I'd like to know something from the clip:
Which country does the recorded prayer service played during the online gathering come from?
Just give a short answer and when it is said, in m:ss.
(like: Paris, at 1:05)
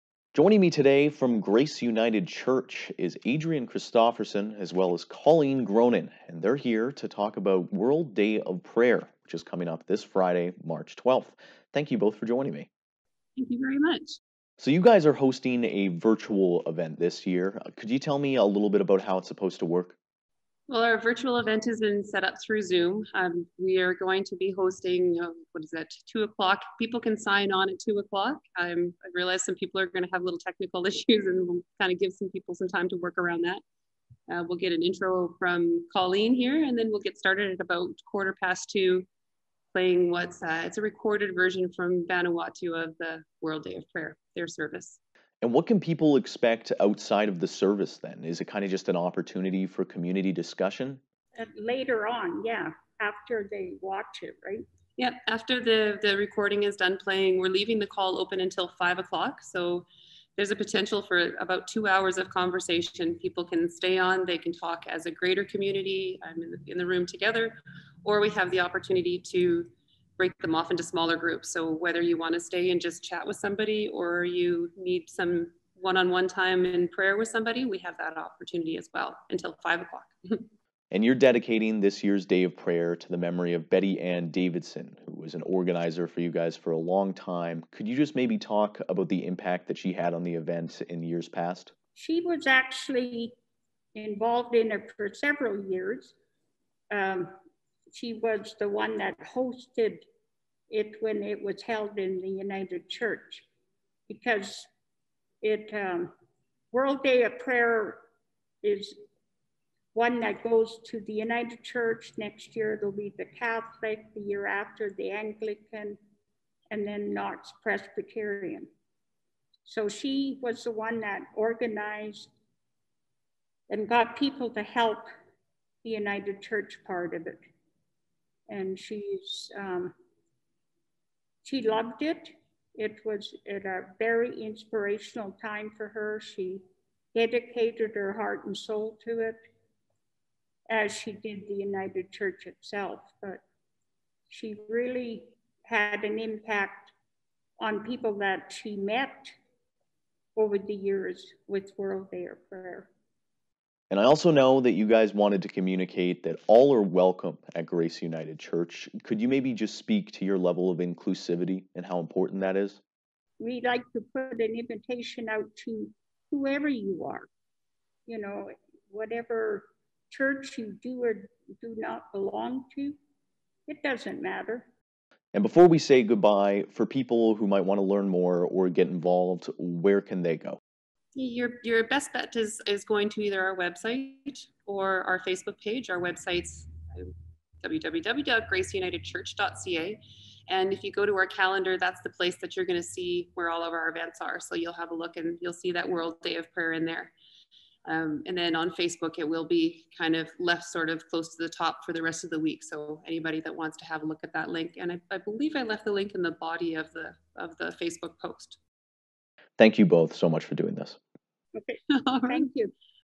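Vanuatu, at 0:42.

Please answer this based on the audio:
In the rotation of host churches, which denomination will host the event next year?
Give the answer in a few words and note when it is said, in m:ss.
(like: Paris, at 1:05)
Catholic, at 1:53.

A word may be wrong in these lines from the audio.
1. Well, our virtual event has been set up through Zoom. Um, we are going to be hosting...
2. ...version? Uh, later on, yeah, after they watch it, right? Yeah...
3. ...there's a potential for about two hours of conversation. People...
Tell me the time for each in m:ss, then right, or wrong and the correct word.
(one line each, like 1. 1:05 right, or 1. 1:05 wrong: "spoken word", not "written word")
1. 0:20 right
2. 0:50 wrong: "discussion", not "version"
3. 1:00 right.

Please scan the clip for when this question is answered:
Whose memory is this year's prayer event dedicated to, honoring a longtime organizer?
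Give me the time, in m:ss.
1:23.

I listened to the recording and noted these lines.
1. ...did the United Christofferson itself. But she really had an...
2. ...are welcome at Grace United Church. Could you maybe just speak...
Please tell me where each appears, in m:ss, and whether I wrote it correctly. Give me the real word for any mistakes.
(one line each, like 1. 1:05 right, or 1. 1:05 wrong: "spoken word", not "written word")
1. 2:21 wrong: "Church", not "Christofferson"
2. 2:36 right.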